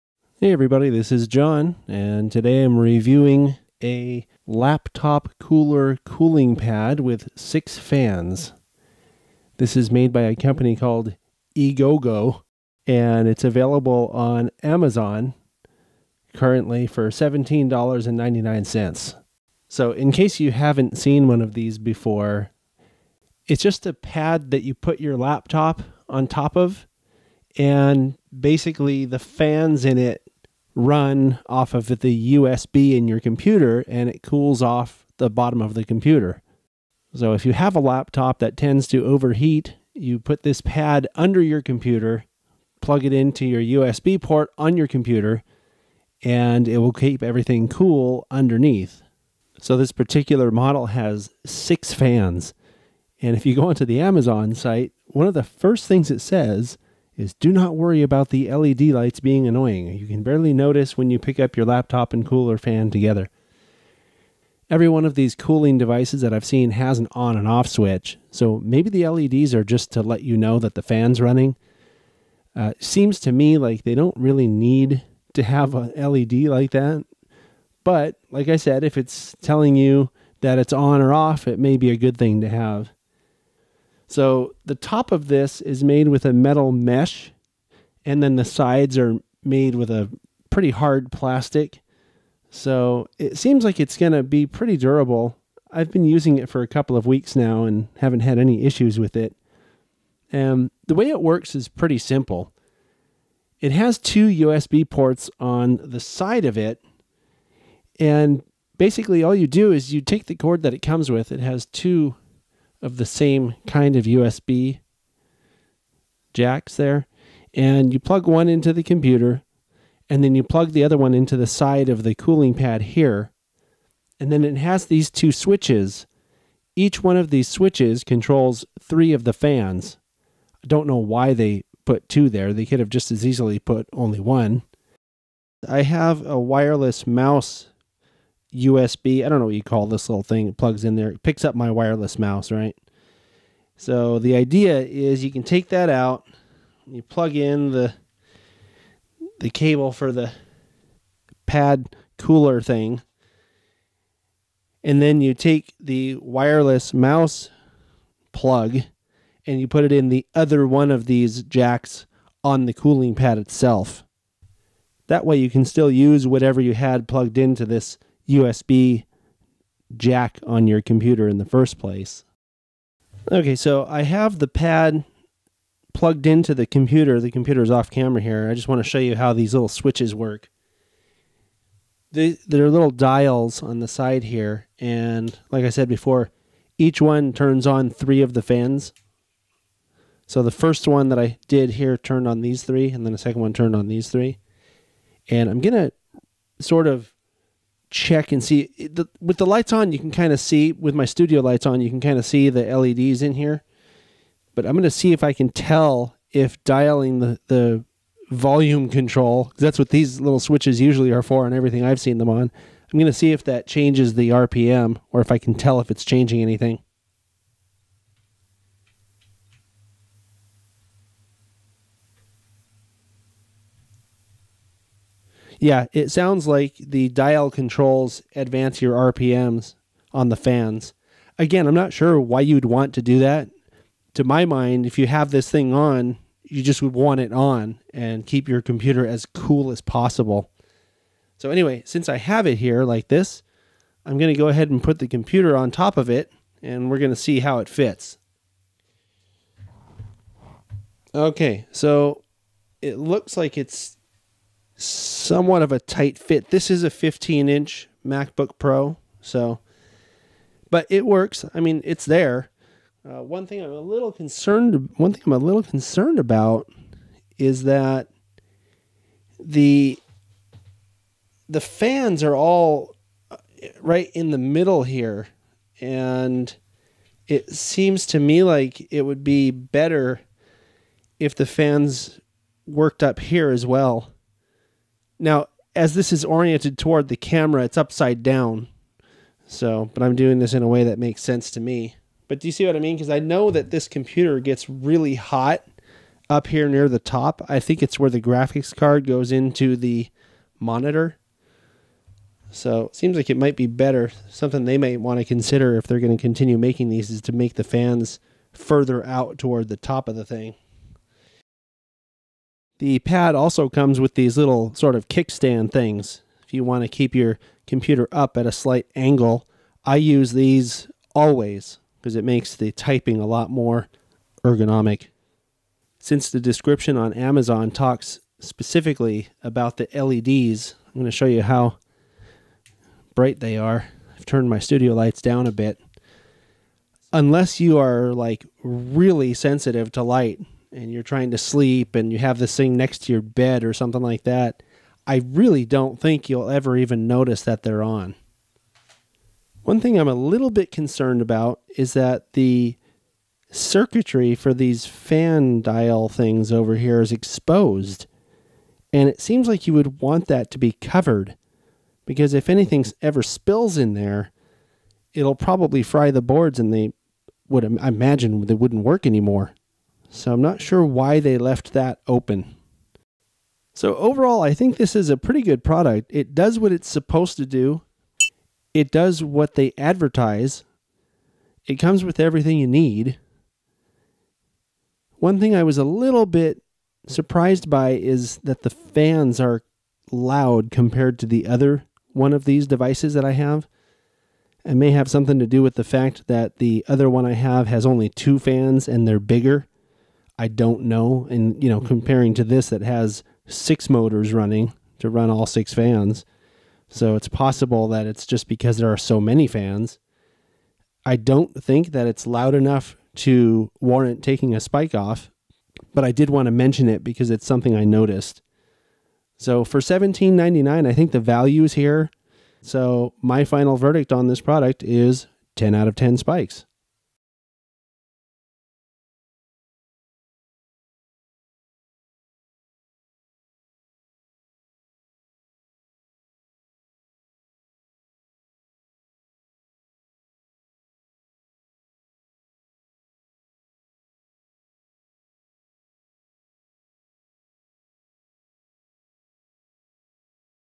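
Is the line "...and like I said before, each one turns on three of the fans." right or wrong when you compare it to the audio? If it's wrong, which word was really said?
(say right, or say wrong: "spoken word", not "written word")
right.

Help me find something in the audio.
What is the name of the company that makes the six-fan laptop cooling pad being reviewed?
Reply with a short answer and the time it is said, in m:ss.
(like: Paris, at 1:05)
Egogo, at 0:11.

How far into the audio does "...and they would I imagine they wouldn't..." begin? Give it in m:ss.
6:06.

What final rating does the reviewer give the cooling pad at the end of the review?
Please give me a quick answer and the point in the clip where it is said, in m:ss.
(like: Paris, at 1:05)
10 out of 10 spikes, at 7:05.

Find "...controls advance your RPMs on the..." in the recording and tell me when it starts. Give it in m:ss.
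3:47.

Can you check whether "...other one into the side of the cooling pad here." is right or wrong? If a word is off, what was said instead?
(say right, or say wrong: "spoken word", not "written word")
right.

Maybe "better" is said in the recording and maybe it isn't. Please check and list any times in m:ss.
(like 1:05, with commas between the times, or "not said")
4:39, 5:03.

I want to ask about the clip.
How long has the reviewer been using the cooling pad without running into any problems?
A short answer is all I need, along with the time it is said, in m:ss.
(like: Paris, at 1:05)
a couple of weeks, at 1:36.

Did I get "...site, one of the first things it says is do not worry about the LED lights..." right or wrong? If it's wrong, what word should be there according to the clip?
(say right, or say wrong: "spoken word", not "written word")
right.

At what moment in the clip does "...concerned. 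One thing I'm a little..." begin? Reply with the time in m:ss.
4:24.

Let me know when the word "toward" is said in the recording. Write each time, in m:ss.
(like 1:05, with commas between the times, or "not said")
4:46, 5:09.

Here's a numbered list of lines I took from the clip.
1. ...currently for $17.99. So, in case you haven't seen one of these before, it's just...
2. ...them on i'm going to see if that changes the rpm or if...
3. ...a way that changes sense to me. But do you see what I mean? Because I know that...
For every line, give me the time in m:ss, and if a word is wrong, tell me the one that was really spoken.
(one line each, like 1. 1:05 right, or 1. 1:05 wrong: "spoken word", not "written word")
1. 0:16 right
2. 3:32 right
3. 4:50 wrong: "makes", not "changes".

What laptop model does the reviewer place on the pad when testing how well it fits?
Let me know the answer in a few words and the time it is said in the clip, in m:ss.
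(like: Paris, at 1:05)
15 inch MacBook Pro, at 4:16.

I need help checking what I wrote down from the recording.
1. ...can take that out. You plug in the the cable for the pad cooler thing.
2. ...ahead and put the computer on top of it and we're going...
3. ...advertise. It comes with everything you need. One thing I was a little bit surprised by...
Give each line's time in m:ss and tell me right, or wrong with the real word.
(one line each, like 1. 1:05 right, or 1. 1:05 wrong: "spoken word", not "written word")
1. 2:25 right
2. 4:04 right
3. 6:19 right.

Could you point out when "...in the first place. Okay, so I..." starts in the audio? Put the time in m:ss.
2:51.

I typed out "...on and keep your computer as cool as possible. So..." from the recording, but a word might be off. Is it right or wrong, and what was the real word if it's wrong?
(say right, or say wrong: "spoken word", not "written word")
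right.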